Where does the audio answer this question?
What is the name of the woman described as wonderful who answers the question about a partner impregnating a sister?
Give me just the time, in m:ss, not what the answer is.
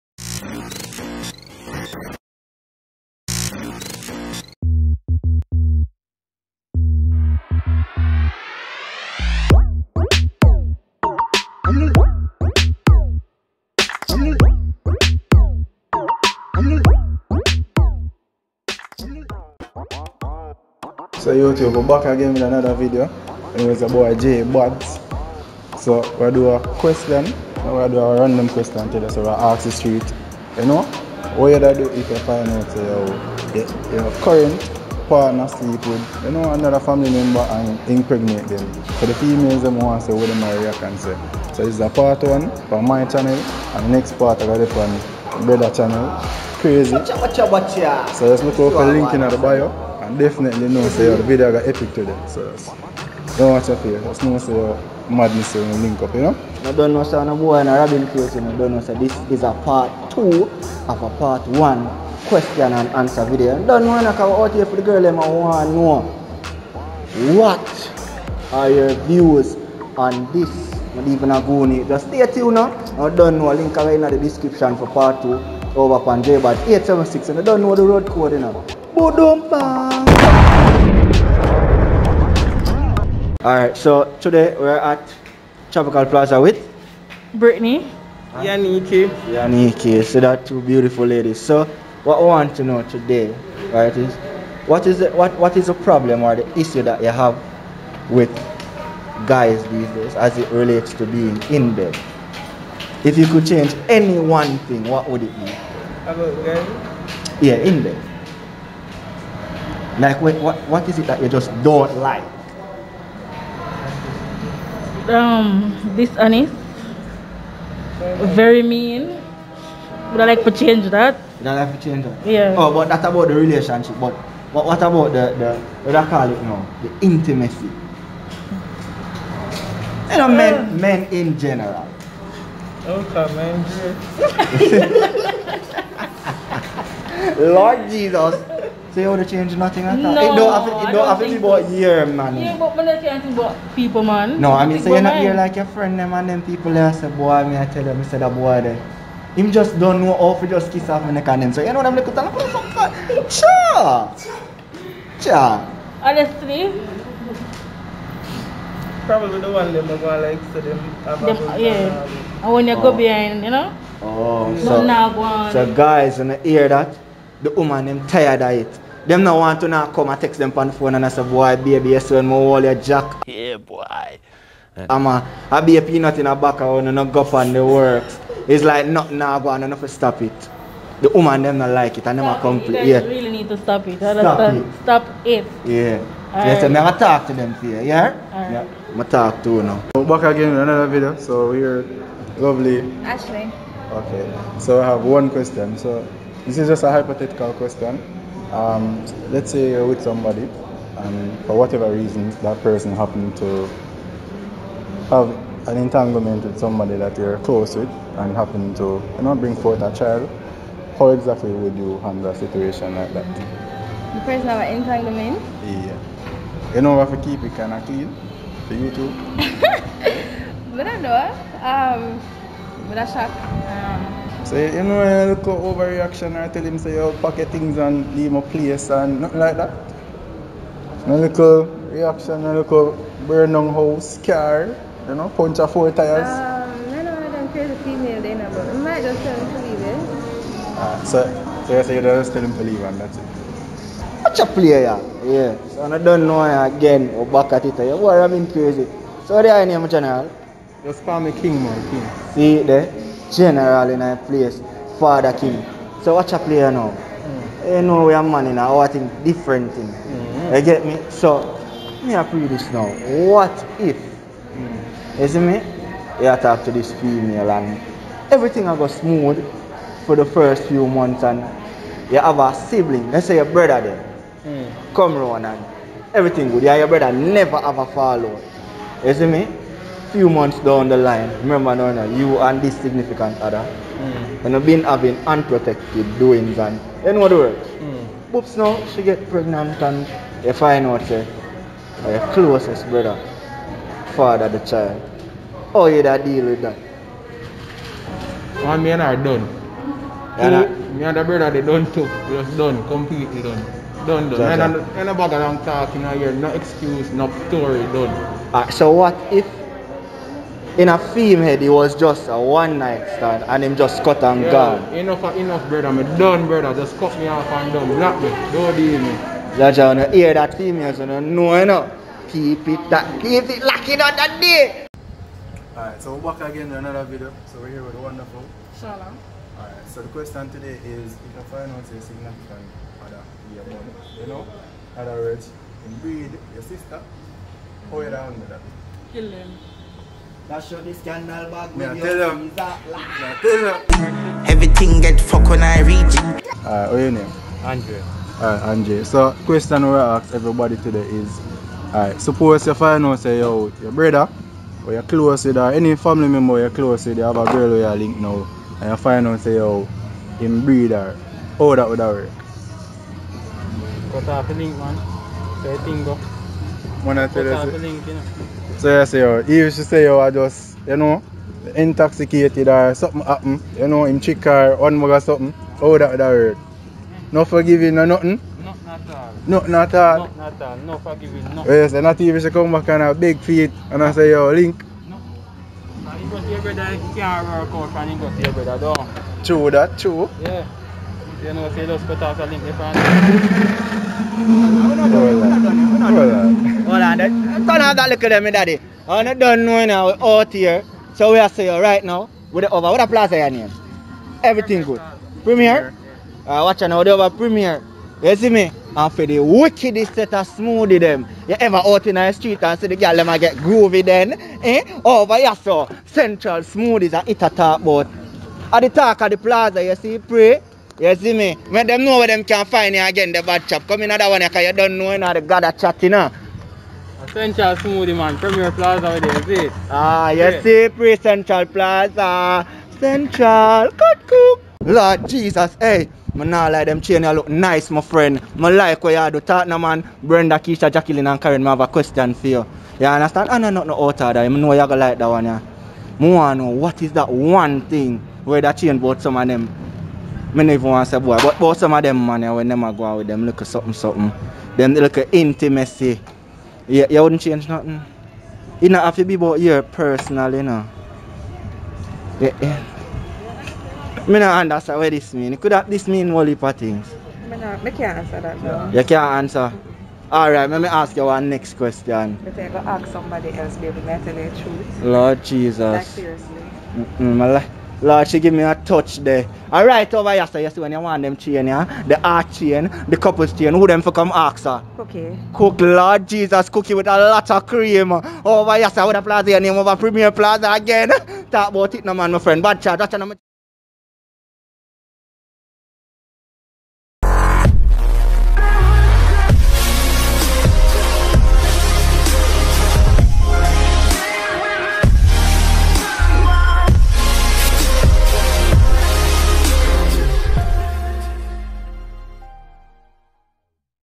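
5:28.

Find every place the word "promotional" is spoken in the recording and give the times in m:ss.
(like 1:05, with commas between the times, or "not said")
not said.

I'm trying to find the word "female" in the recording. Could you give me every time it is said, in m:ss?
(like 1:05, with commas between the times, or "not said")
0:39, 3:57, 4:26.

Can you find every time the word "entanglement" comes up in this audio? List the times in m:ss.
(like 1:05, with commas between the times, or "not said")
3:25, 3:34.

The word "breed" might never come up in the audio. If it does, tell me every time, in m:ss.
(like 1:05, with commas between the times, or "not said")
5:35, 6:00.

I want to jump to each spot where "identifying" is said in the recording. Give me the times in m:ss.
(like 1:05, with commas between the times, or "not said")
not said.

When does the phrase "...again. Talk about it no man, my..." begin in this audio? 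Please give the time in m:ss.
8:10.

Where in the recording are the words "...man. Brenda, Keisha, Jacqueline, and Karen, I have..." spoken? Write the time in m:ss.
7:19.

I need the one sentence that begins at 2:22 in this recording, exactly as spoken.
Yeah, but man, I can't think about people, man.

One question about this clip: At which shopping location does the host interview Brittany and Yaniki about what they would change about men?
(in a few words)
Tropical Plaza.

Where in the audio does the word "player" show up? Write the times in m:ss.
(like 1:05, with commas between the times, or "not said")
4:04, 4:16.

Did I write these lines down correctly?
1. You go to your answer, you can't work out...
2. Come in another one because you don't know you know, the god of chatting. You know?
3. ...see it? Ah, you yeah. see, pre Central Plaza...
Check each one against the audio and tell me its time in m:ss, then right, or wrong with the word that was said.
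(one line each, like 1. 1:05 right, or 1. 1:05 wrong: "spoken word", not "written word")
1. 6:26 wrong: "brother", not "answer"
2. 7:03 right
3. 7:09 right.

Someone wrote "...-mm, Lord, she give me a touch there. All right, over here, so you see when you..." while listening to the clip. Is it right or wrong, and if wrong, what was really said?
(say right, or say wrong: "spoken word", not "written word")
right.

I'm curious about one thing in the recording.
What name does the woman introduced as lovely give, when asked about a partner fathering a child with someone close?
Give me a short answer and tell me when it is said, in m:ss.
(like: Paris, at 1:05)
Ashley, at 3:13.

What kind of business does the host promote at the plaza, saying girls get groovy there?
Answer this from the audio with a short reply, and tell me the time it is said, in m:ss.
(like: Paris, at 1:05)
Central Smoothies, at 6:56.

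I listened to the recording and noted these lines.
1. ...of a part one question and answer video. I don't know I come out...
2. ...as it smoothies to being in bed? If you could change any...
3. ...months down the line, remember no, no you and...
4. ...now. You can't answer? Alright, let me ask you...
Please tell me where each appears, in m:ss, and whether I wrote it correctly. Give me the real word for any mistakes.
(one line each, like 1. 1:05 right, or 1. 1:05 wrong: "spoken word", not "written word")
1. 1:00 right
2. 1:40 wrong: "relates", not "smoothies"
3. 4:40 right
4. 7:48 right.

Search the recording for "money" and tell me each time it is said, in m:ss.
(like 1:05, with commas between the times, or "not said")
not said.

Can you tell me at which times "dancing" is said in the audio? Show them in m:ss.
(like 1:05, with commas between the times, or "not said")
not said.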